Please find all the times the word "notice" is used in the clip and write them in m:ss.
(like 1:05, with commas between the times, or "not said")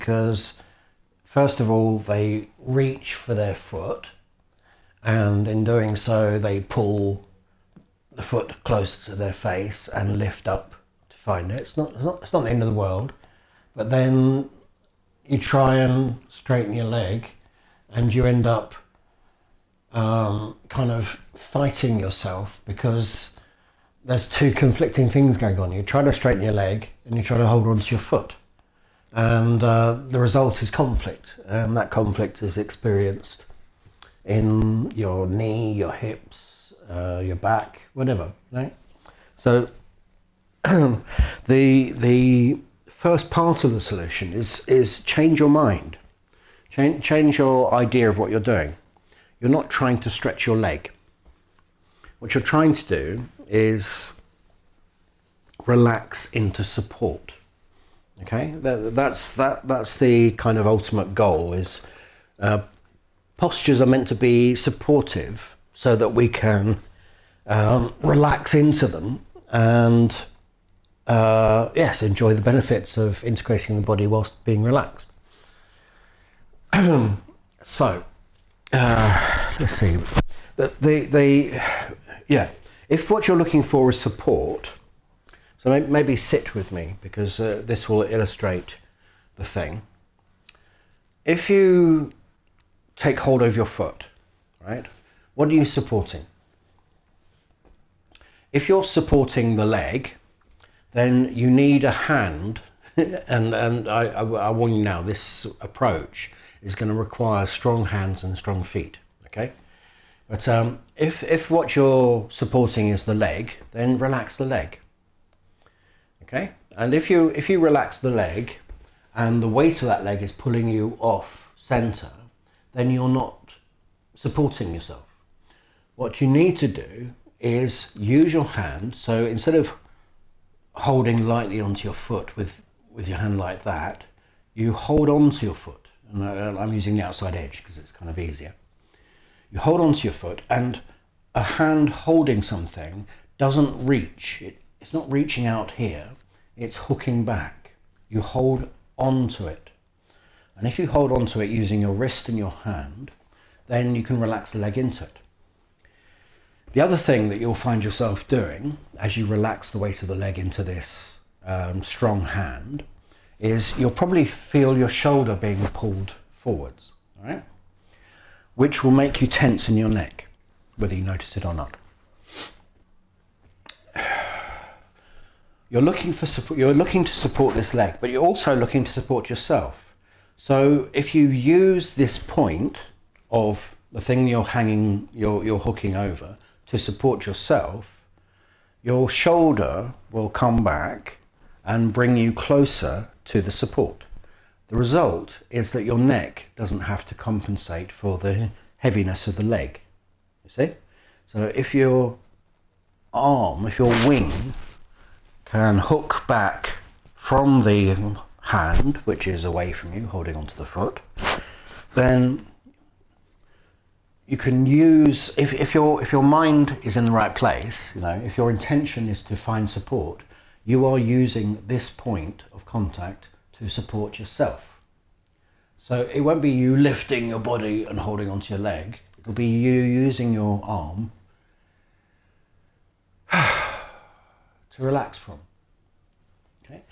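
2:51.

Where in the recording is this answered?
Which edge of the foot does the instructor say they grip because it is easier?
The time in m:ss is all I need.
2:17.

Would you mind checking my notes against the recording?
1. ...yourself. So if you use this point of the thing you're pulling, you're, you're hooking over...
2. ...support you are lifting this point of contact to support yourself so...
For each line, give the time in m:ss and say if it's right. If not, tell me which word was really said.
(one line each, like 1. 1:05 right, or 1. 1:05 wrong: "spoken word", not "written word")
1. 2:59 wrong: "hanging", not "pulling"
2. 3:39 wrong: "using", not "lifting".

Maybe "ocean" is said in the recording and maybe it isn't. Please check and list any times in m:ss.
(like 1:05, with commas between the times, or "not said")
not said.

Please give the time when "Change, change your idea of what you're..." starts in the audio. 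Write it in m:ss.
0:46.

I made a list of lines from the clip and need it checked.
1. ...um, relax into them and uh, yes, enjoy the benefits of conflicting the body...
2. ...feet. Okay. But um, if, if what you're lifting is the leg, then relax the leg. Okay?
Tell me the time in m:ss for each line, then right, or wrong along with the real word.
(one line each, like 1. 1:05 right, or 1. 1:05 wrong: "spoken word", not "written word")
1. 1:07 wrong: "integrating", not "conflicting"
2. 1:48 wrong: "supporting", not "lifting".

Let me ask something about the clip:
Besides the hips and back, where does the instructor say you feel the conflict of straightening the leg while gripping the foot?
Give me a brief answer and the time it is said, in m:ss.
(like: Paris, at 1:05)
knee, at 0:34.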